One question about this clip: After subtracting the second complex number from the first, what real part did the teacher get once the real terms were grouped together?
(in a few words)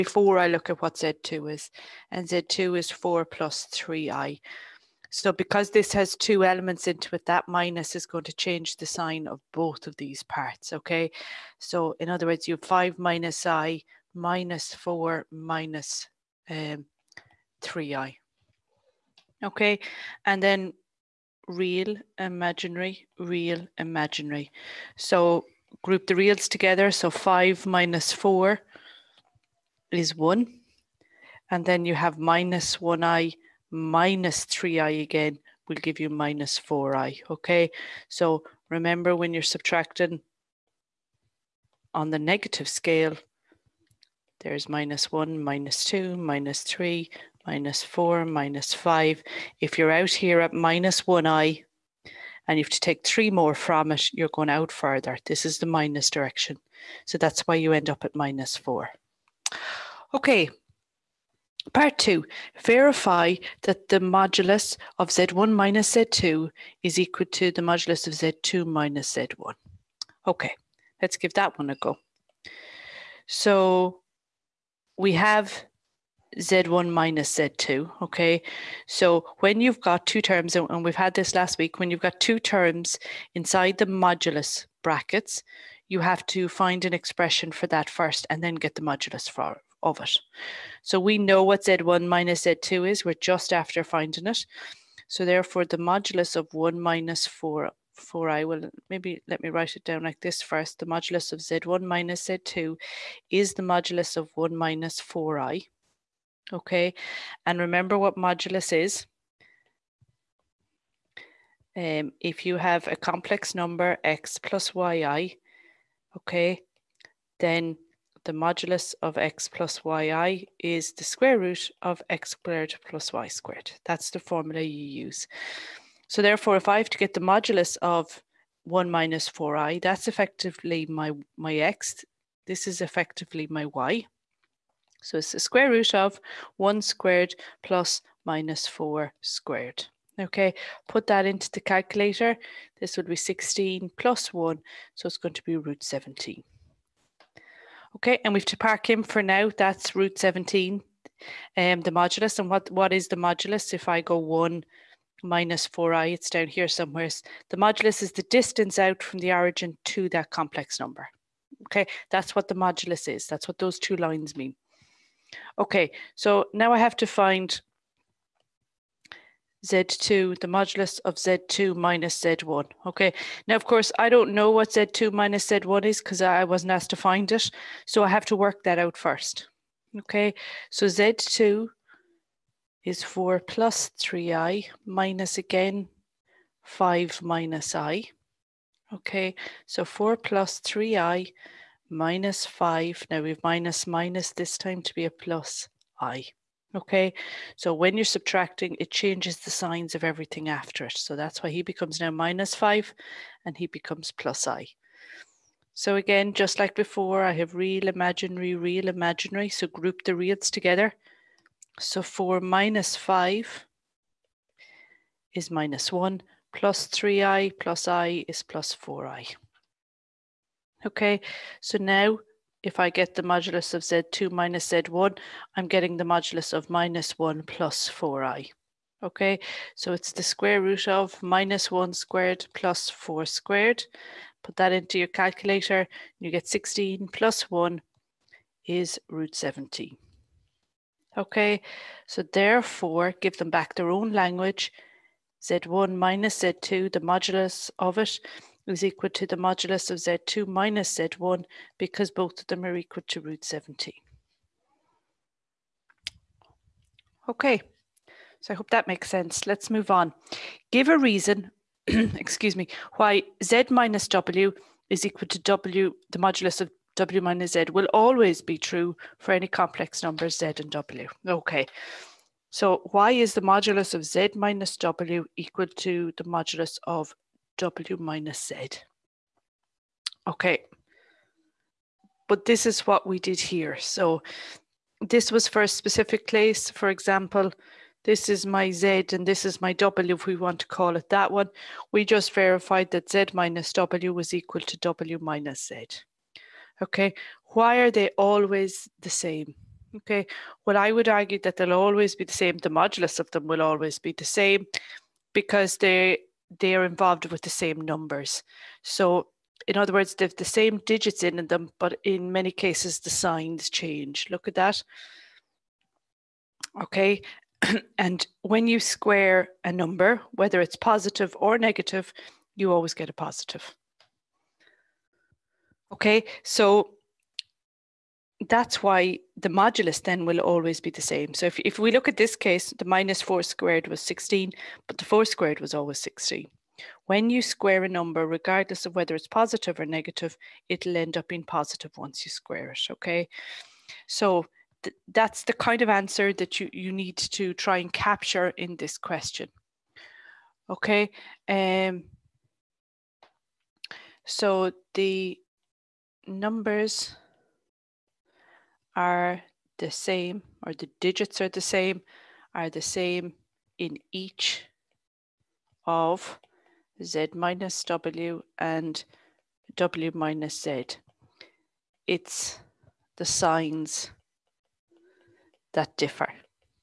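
1.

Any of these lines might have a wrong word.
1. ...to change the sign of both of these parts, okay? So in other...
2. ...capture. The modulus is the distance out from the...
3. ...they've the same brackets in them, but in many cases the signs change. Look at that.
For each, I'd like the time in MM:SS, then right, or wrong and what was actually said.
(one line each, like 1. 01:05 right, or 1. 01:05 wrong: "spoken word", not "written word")
1. 00:08 right
2. 02:36 wrong: "somewhere", not "capture"
3. 05:10 wrong: "digits", not "brackets".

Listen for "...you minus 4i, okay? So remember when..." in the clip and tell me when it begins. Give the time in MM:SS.
00:35.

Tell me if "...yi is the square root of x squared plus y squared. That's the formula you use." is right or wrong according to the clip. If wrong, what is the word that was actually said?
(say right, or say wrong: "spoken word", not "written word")
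right.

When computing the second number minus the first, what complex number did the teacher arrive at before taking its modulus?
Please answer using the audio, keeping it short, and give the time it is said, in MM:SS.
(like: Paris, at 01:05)
-1 + 4i, at 03:46.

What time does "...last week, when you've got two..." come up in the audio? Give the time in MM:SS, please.
01:21.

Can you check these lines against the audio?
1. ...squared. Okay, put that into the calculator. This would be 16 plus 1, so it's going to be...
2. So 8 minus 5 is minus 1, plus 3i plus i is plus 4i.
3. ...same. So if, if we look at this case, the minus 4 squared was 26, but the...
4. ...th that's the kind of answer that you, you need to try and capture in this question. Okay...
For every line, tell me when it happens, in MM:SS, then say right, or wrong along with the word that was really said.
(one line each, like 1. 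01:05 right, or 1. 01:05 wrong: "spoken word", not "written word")
1. 02:19 right
2. 03:31 wrong: "4", not "8"
3. 05:31 wrong: "16", not "26"
4. 05:44 right.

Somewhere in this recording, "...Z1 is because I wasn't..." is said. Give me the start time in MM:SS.
02:55.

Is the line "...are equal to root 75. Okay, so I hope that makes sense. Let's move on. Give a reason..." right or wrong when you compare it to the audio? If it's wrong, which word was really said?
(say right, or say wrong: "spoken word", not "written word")
wrong: "70", not "75".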